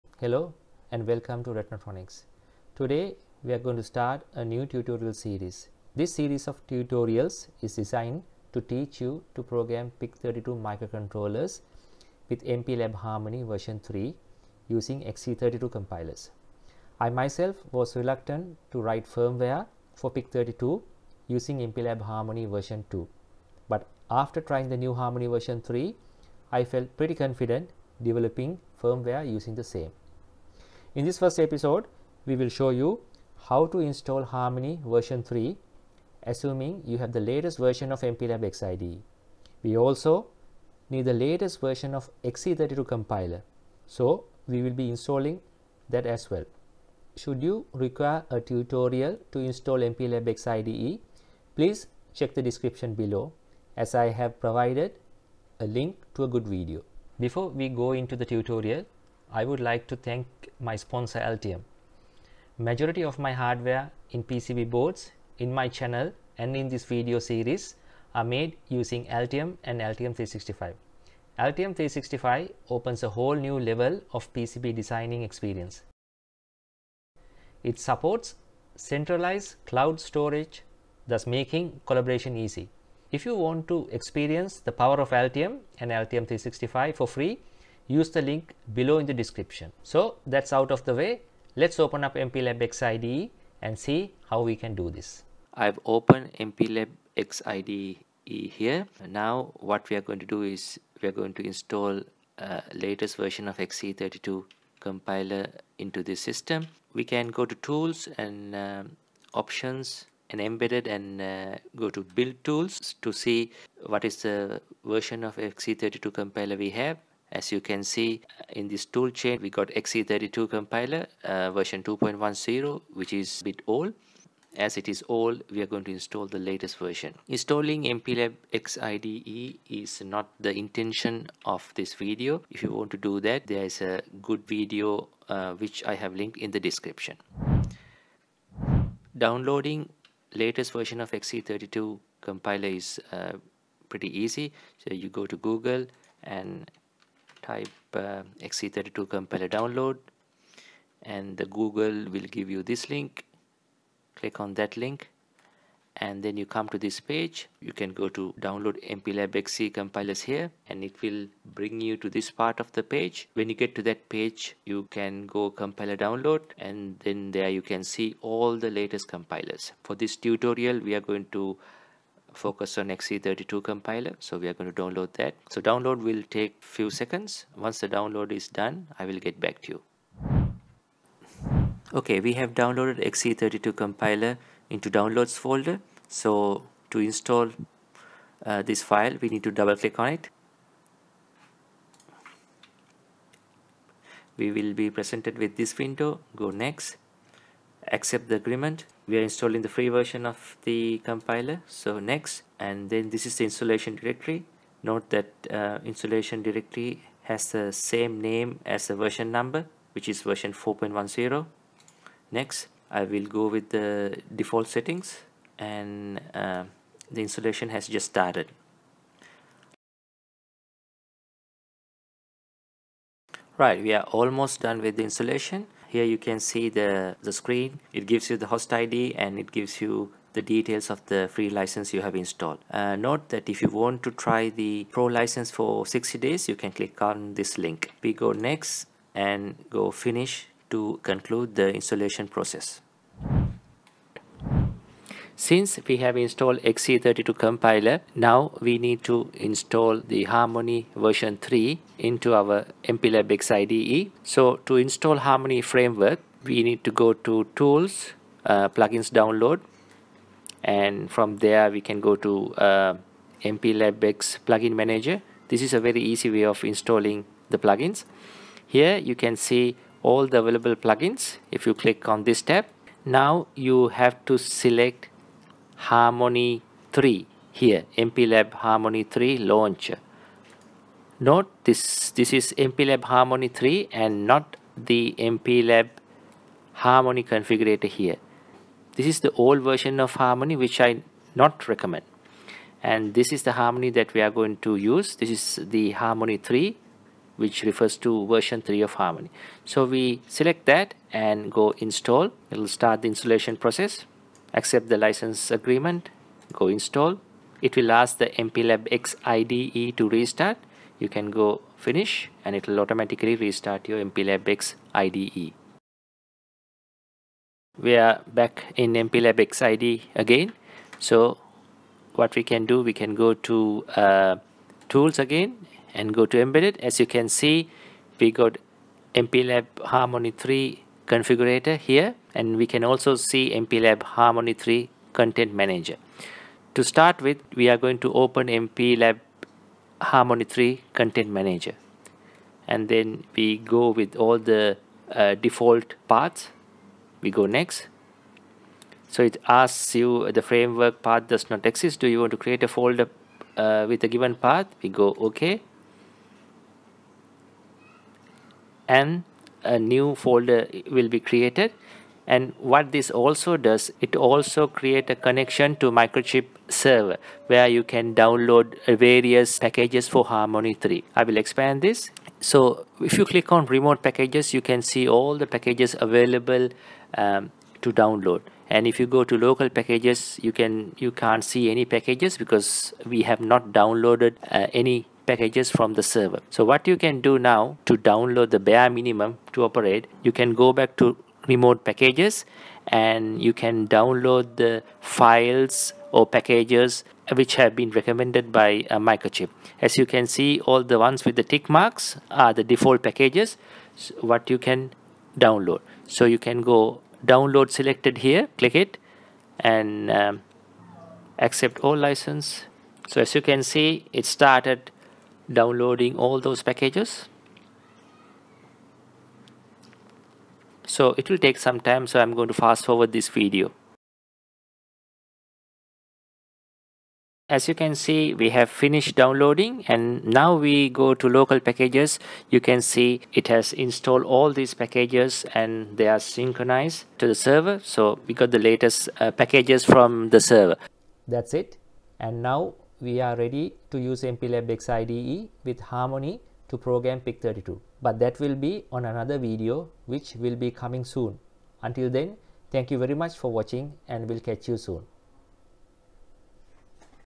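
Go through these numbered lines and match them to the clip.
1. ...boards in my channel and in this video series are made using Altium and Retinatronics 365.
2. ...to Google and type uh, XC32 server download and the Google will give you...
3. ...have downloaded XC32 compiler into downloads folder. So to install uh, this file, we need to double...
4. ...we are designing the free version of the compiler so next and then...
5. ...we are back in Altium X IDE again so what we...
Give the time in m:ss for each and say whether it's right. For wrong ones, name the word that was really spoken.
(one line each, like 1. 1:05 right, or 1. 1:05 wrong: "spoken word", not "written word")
1. 1:04 wrong: "Altium", not "Retinatronics"
2. 2:25 wrong: "compiler", not "server"
3. 3:02 right
4. 3:19 wrong: "installing", not "designing"
5. 5:17 wrong: "MPLAB", not "Altium".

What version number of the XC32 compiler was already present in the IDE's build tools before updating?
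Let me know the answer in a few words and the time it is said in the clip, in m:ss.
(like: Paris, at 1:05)
2.10, at 2:01.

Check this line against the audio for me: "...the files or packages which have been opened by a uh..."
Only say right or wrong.
wrong.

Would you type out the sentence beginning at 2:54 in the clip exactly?
So we are going to download that.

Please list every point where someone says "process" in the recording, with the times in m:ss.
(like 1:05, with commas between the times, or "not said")
4:02, 5:03.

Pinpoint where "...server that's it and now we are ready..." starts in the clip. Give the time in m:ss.
7:20.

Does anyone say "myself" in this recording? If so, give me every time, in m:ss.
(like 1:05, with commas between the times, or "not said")
0:17.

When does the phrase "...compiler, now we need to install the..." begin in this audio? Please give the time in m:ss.
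4:07.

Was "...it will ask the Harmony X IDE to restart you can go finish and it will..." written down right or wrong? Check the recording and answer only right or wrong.
wrong.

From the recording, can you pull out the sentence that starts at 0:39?
We also need the latest version of XC32 compiler.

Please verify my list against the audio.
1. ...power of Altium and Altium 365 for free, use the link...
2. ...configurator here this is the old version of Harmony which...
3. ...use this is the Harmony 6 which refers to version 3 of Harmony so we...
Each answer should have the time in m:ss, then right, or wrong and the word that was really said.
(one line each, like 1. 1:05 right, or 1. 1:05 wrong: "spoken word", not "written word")
1. 1:24 right
2. 4:47 right
3. 4:54 wrong: "3", not "6".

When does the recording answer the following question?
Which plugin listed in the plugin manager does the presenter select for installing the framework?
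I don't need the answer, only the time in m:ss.
4:37.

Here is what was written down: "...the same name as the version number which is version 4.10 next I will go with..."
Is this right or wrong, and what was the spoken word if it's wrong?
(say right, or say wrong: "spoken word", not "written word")
right.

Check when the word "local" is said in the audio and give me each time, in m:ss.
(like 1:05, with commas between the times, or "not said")
6:19, 7:11.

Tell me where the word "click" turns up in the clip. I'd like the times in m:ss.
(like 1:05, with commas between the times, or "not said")
2:34, 3:09, 3:56, 4:31, 6:13, 6:48.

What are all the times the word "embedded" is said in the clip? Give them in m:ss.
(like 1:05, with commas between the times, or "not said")
1:50, 5:26.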